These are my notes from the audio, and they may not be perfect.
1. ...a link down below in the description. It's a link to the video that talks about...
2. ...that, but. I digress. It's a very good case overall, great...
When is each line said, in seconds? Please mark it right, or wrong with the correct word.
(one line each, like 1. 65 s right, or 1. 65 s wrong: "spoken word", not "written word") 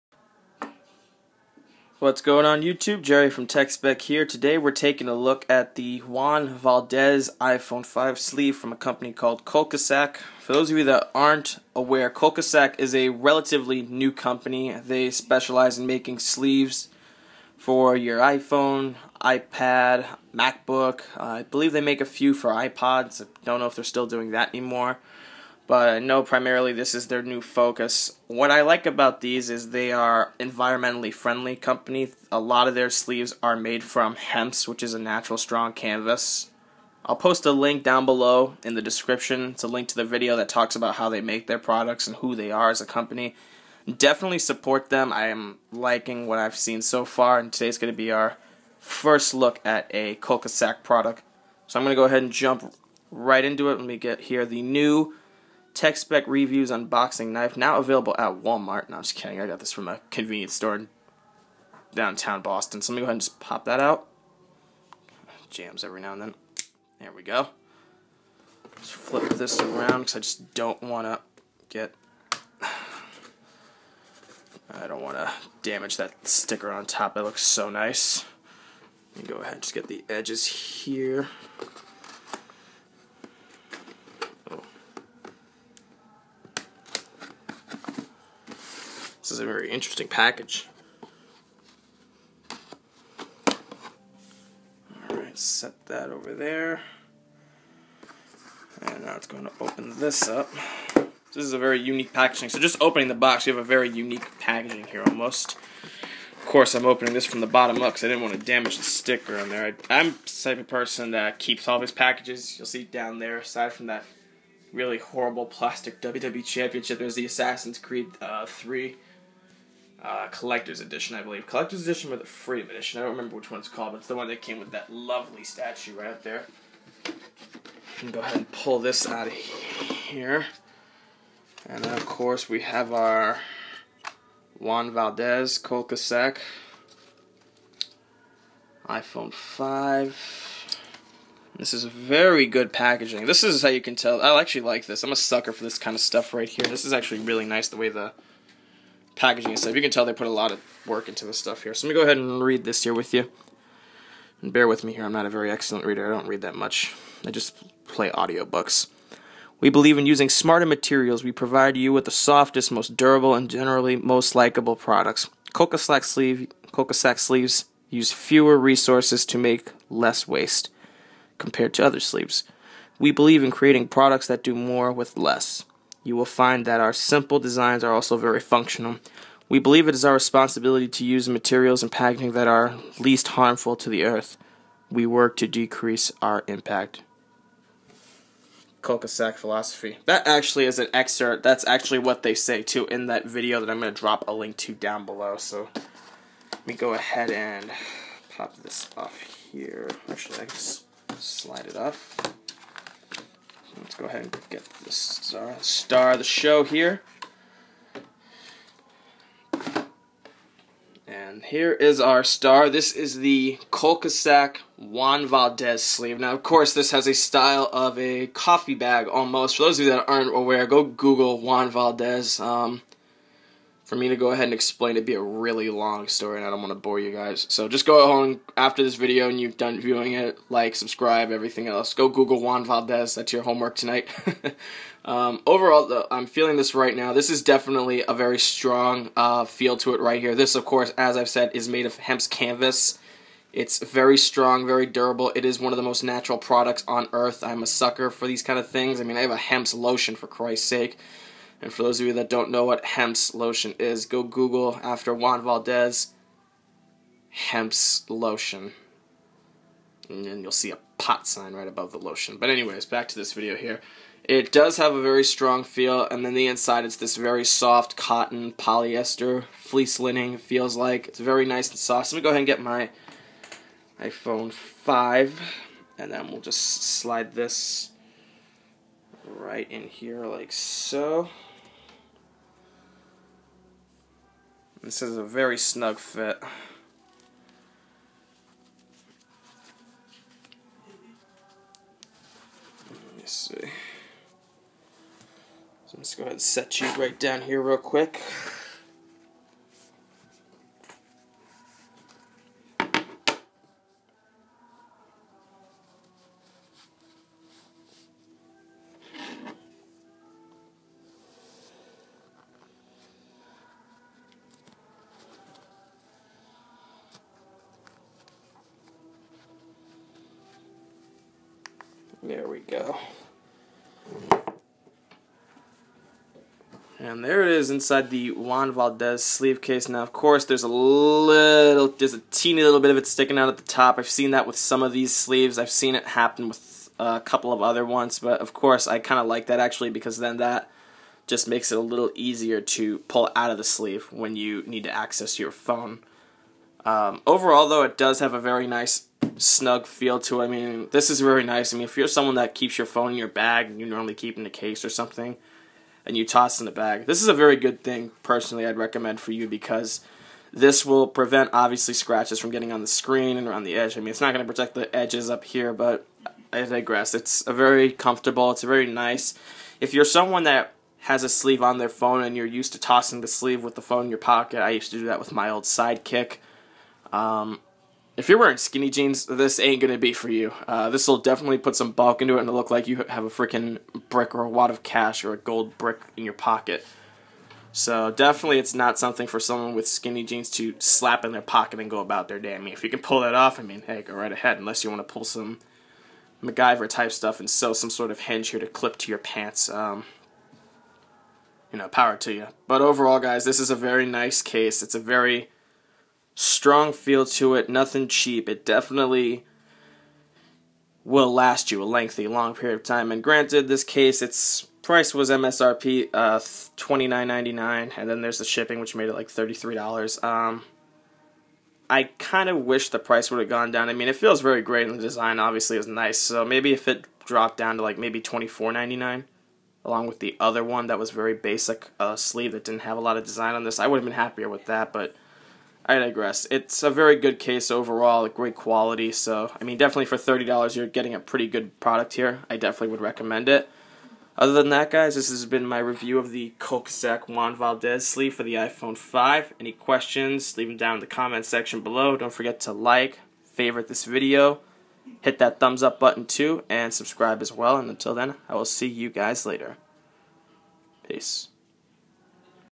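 1. 37 s right
2. 434 s right.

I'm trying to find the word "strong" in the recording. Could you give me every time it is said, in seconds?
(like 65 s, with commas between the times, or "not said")
35 s, 238 s, 244 s, 265 s, 406 s.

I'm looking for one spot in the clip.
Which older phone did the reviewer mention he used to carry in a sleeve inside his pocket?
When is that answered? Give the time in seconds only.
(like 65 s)
375 s.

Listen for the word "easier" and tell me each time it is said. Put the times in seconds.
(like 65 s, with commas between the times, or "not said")
342 s.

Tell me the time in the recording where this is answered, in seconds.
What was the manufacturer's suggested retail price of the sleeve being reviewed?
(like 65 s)
416 s.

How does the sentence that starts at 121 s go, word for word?
Collector's edition or the Freedom edition.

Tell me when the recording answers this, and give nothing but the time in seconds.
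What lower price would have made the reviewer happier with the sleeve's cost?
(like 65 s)
428 s.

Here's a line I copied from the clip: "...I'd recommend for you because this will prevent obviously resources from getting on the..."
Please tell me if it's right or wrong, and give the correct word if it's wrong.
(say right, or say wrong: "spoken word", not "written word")
wrong: "scratches", not "resources".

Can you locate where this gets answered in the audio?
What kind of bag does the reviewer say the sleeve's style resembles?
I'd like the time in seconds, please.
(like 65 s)
218 s.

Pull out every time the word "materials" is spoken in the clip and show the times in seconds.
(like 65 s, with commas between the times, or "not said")
160 s, 181 s.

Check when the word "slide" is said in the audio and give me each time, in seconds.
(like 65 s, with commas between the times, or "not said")
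201 s, 276 s.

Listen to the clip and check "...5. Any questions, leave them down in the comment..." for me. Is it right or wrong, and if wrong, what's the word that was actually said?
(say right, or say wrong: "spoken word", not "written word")
right.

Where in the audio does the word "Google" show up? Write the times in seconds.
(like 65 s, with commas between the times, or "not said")
220 s, 232 s, 254 s.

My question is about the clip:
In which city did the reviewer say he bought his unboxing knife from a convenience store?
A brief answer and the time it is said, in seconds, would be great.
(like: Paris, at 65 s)
Boston, at 62 s.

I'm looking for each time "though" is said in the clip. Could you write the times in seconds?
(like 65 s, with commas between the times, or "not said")
235 s, 347 s.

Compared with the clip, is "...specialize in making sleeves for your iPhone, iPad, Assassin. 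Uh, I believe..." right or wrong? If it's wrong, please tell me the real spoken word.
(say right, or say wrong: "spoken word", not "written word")
wrong: "MacBook", not "Assassin".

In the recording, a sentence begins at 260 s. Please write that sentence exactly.
And then you'll see a pot sign right above the lotion.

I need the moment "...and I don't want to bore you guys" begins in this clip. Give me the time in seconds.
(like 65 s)
226 s.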